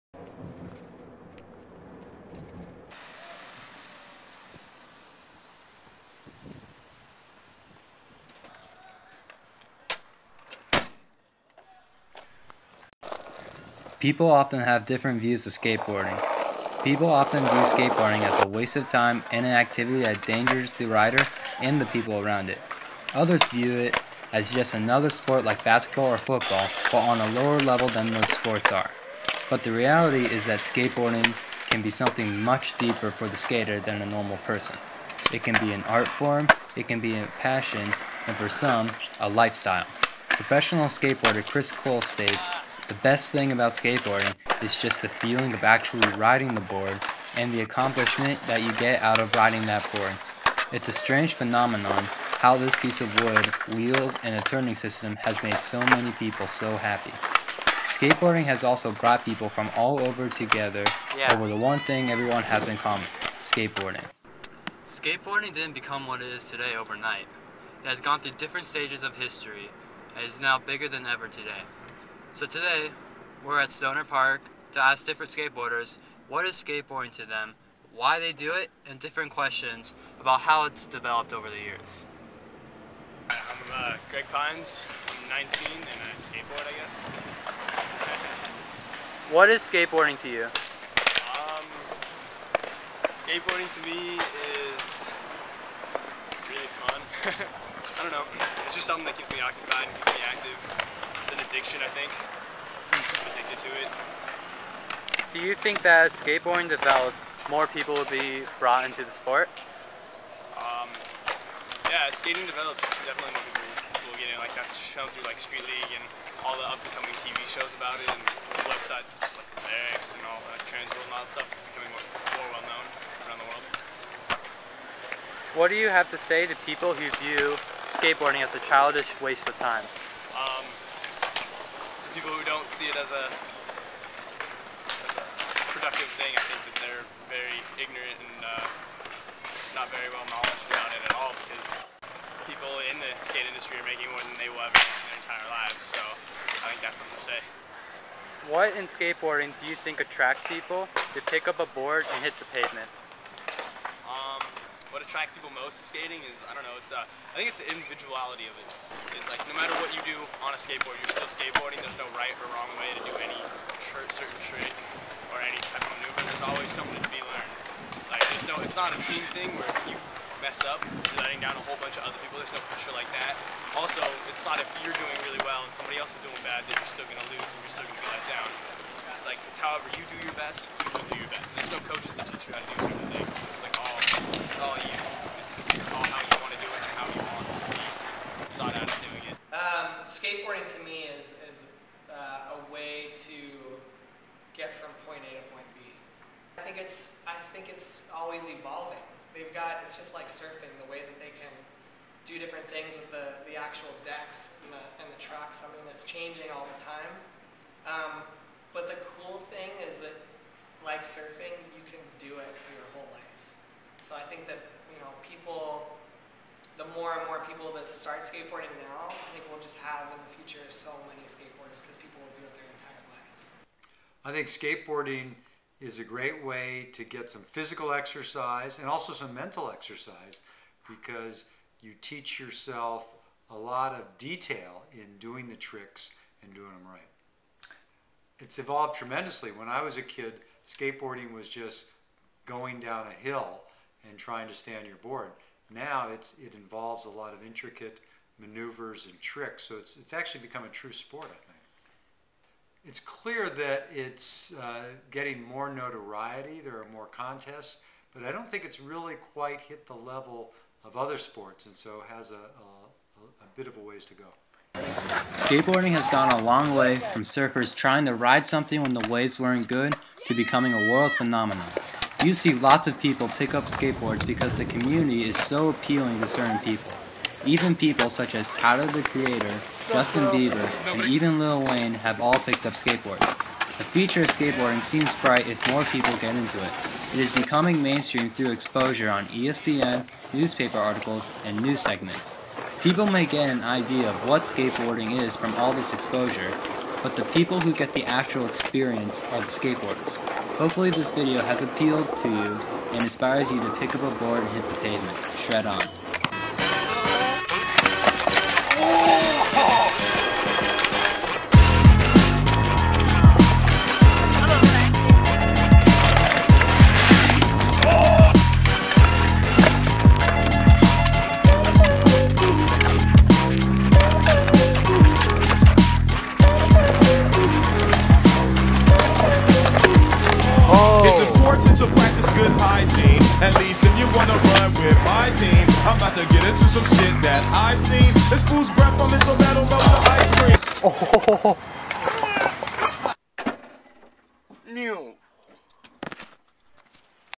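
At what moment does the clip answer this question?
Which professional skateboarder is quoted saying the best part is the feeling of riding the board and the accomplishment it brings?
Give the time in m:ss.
0:41.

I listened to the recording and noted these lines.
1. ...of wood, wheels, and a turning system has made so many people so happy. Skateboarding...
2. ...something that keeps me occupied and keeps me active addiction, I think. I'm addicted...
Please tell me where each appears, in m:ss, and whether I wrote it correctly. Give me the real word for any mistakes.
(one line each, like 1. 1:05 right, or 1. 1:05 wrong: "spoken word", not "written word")
1. 0:52 right
2. 1:38 right.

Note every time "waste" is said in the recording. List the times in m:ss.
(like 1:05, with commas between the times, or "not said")
0:18, 2:09.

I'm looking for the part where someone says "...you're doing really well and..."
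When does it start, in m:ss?
2:54.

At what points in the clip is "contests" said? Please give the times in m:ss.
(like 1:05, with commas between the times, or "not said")
4:17.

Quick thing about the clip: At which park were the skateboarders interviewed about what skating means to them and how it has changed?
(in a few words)
Stoner Park.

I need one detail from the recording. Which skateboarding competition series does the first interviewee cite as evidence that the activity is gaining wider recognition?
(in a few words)
Street League.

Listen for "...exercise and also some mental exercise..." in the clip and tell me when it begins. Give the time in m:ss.
3:47.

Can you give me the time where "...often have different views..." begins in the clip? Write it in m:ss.
0:14.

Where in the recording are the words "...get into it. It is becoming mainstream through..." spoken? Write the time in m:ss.
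4:46.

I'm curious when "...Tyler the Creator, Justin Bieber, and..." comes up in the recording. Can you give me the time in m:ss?
4:38.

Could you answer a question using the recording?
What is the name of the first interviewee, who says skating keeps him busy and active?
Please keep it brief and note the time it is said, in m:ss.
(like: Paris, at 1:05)
Greg Pines, at 1:24.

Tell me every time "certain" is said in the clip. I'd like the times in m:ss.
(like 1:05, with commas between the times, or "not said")
2:44, 3:02, 4:36.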